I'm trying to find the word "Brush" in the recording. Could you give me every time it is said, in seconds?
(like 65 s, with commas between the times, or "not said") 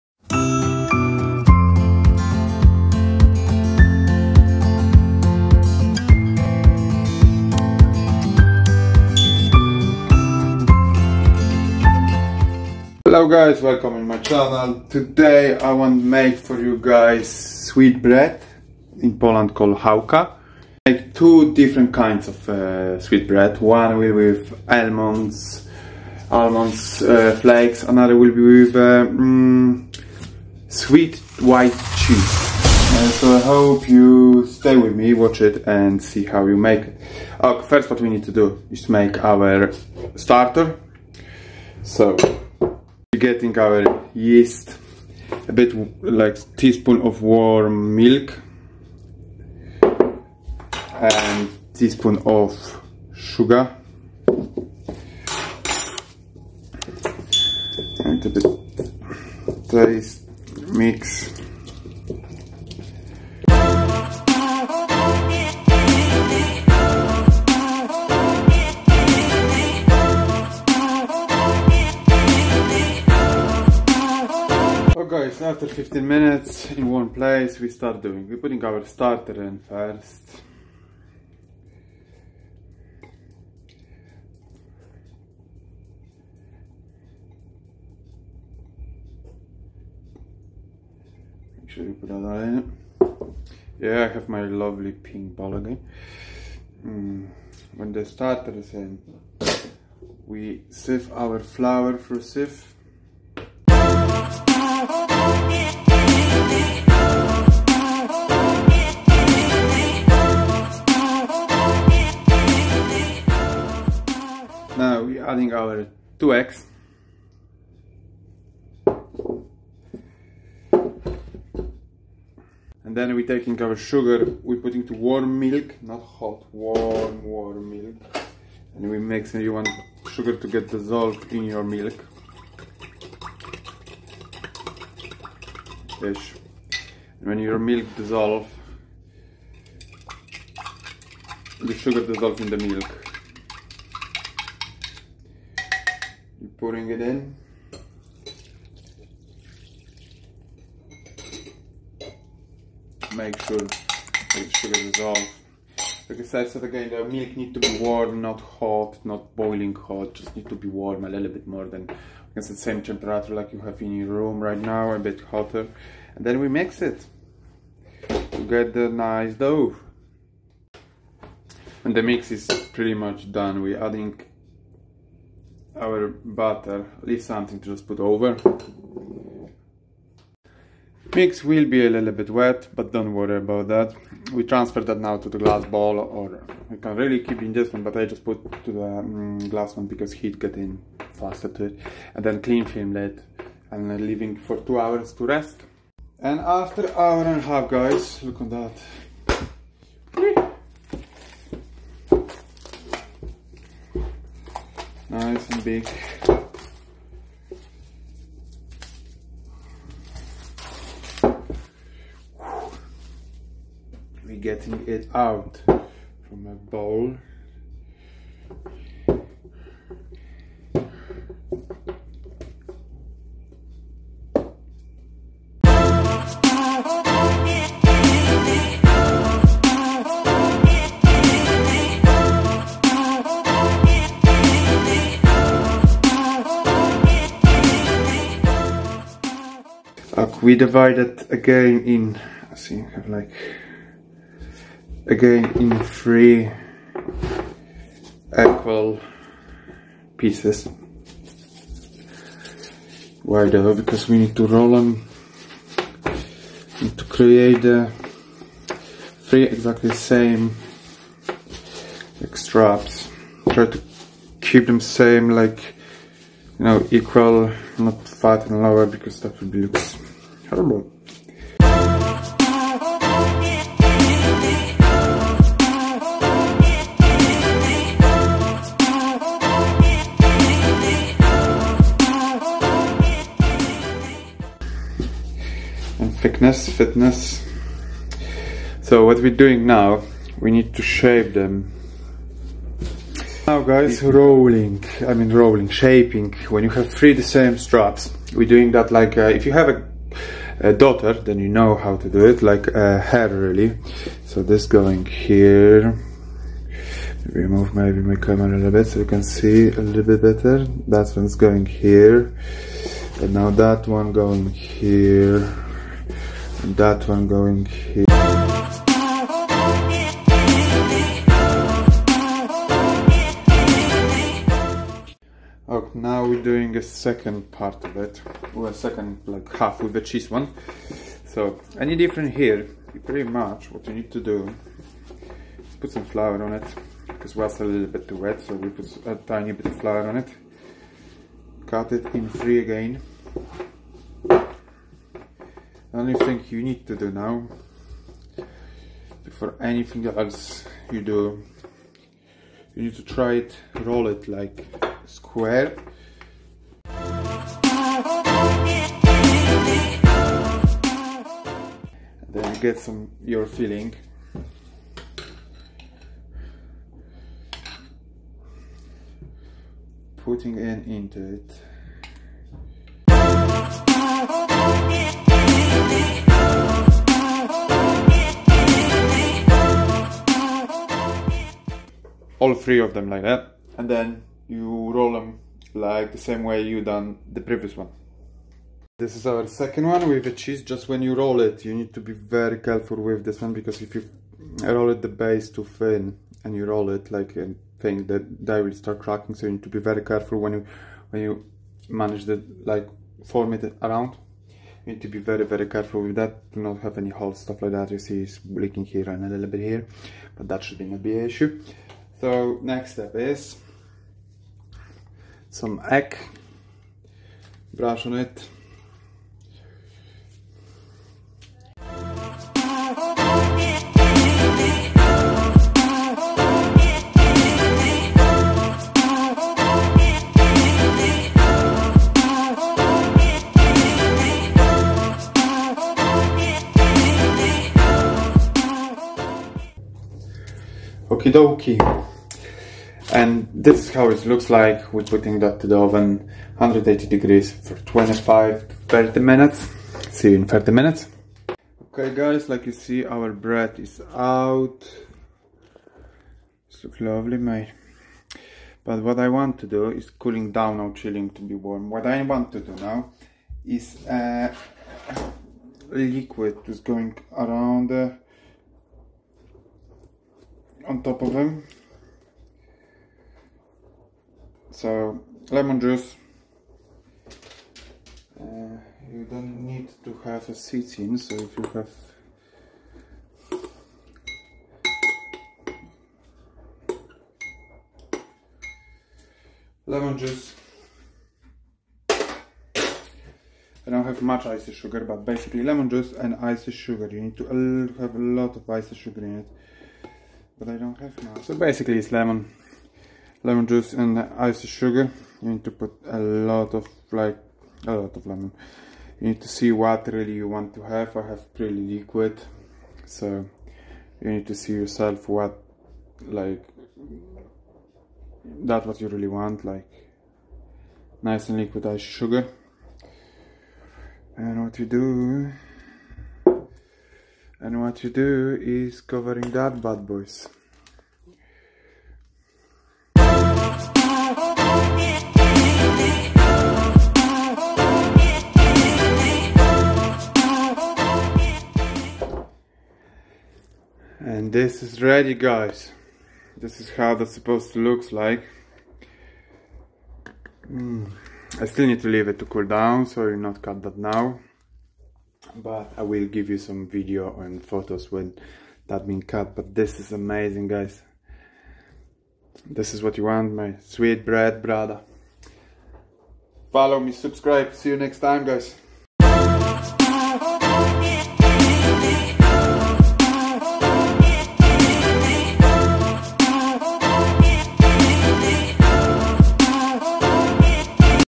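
417 s.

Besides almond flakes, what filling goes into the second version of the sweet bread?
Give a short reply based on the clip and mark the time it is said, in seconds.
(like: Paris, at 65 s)
sweet white cheese, at 30 s.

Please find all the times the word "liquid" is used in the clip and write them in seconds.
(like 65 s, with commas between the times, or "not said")
465 s, 511 s, 521 s.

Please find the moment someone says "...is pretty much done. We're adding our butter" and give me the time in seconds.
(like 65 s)
172 s.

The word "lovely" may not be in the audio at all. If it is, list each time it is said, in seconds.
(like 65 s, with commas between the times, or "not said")
94 s, 457 s.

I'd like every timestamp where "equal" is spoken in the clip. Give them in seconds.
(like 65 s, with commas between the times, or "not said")
248 s, 266 s.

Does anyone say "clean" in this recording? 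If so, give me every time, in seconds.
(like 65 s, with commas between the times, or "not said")
192 s.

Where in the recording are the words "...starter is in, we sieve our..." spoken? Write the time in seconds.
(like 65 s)
98 s.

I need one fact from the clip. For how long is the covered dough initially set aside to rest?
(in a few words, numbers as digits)
two hours.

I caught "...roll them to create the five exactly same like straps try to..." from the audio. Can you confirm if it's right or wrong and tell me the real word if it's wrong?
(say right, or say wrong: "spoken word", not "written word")
wrong: "three", not "five".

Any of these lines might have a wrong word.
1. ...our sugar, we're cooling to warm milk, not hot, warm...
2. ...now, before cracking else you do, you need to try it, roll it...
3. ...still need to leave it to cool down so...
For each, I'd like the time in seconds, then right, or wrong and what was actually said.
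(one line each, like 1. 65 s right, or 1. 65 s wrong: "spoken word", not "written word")
1. 123 s wrong: "putting", not "cooling"
2. 347 s wrong: "anything", not "cracking"
3. 551 s right.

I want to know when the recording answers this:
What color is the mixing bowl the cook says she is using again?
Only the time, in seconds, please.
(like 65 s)
94 s.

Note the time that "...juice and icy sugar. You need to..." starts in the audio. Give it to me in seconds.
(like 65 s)
495 s.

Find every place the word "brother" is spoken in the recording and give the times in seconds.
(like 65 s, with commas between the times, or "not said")
564 s.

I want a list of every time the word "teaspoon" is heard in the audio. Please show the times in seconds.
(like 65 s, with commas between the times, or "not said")
46 s, 51 s.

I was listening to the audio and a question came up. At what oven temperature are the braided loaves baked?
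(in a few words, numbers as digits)
180 degrees.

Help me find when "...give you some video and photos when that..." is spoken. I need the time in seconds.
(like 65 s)
556 s.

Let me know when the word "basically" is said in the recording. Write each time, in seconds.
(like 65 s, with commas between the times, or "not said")
495 s, 501 s.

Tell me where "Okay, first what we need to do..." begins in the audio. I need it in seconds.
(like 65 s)
37 s.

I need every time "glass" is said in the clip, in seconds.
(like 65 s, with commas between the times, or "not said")
185 s, 189 s.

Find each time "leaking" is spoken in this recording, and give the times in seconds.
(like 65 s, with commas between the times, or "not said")
408 s.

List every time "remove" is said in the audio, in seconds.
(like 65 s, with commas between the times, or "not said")
307 s.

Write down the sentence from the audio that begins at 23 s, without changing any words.
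One will be with almonds, almonds uh, flakes.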